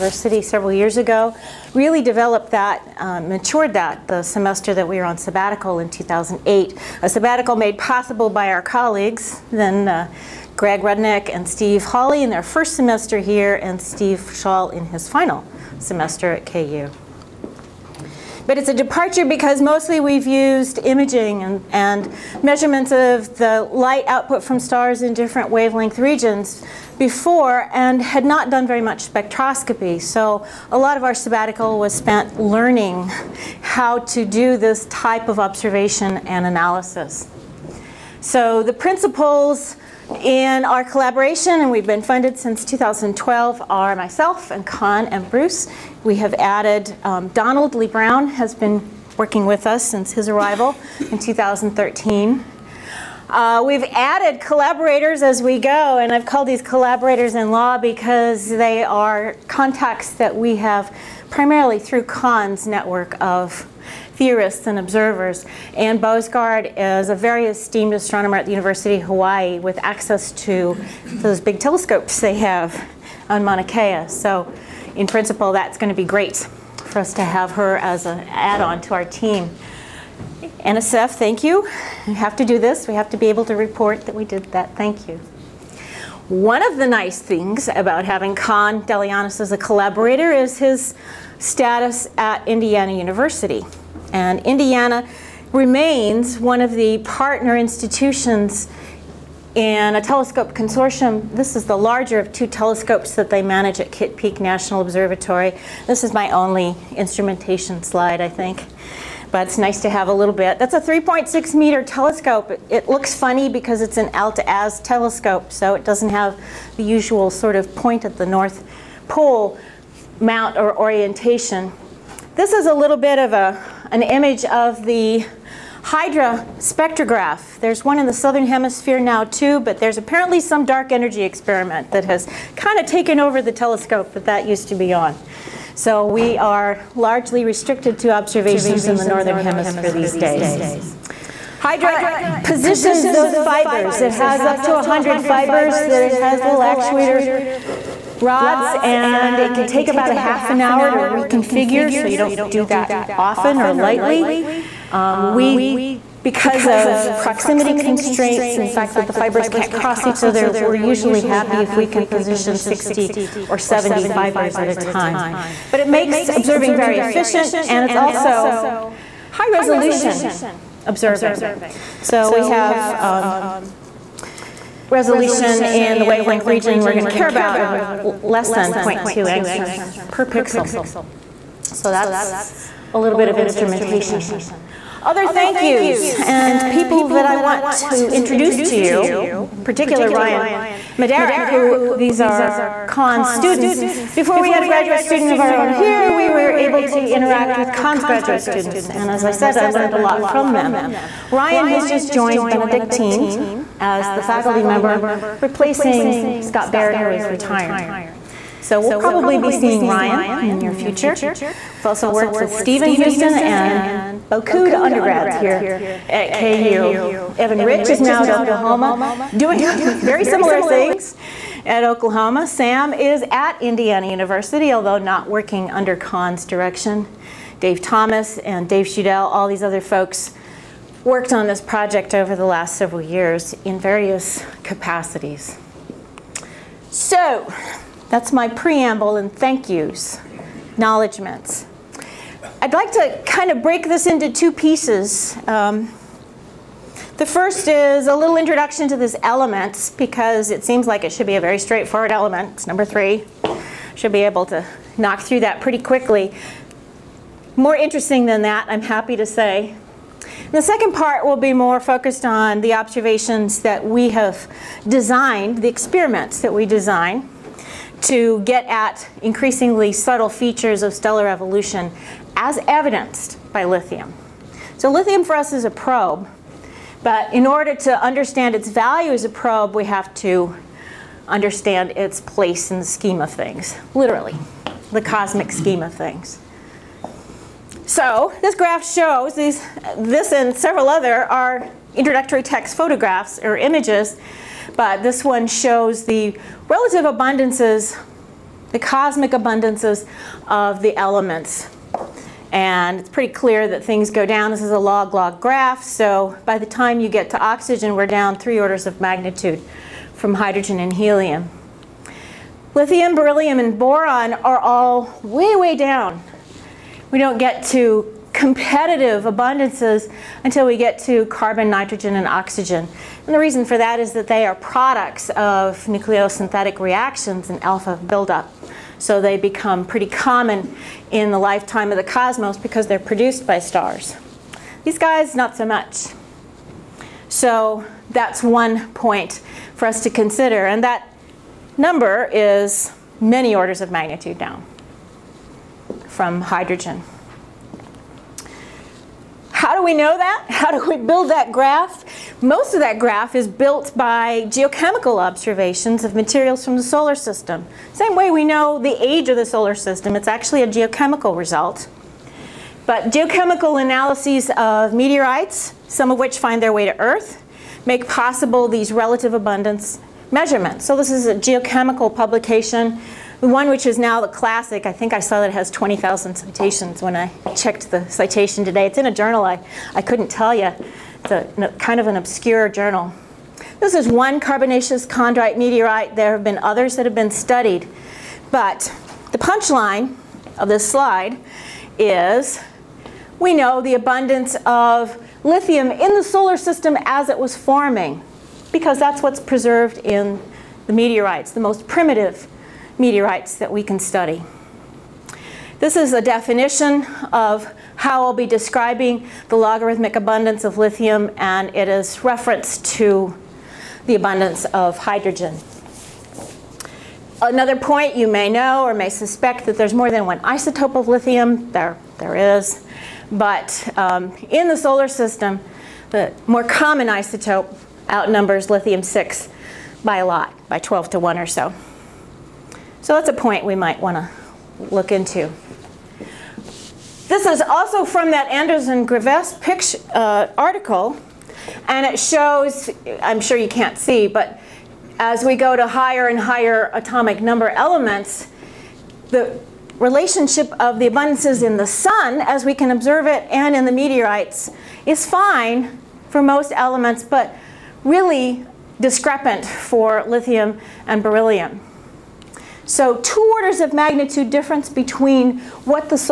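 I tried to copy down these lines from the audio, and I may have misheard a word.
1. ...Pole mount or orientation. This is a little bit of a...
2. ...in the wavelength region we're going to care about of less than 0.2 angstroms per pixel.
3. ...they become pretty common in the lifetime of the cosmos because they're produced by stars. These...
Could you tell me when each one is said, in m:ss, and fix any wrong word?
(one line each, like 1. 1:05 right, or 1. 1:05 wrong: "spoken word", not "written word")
1. 1:59 right
2. 2:55 right
3. 5:29 right.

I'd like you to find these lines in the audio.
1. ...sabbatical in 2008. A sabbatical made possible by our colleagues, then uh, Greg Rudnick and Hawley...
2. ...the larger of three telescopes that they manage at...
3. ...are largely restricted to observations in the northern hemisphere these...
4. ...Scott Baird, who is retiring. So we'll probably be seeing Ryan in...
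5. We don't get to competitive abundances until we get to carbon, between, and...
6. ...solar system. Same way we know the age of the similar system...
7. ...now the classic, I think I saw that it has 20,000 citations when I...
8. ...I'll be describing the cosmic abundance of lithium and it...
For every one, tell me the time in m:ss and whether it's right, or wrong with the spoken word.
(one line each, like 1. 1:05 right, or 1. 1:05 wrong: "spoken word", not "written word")
1. 0:05 wrong: "Steve", not "Hawley"
2. 1:41 wrong: "two", not "three"
3. 2:16 right
4. 3:26 right
5. 5:17 wrong: "nitrogen", not "between"
6. 5:56 wrong: "solar", not "similar"
7. 6:13 right
8. 6:48 wrong: "logarithmic", not "cosmic".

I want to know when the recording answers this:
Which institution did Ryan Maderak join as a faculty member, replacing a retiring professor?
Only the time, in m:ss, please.
3:22.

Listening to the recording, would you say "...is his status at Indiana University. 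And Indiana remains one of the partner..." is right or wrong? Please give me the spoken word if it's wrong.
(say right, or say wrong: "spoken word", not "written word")
right.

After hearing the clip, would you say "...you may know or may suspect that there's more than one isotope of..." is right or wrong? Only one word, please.
right.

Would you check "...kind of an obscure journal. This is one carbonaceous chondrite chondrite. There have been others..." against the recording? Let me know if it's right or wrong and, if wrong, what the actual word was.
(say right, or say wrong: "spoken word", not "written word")
wrong: "meteorite", not "chondrite".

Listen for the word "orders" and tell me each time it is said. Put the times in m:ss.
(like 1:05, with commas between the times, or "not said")
4:37, 5:08, 5:43, 7:43.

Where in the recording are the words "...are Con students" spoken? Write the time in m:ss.
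3:12.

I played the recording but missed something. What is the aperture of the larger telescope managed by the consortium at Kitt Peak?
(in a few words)
3.6 meters.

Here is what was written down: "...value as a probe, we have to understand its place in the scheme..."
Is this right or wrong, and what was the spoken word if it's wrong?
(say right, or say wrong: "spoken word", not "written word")
right.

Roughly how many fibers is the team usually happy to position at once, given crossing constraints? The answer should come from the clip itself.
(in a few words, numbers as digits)
60 or 70.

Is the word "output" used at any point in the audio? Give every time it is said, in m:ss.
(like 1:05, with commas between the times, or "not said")
0:24.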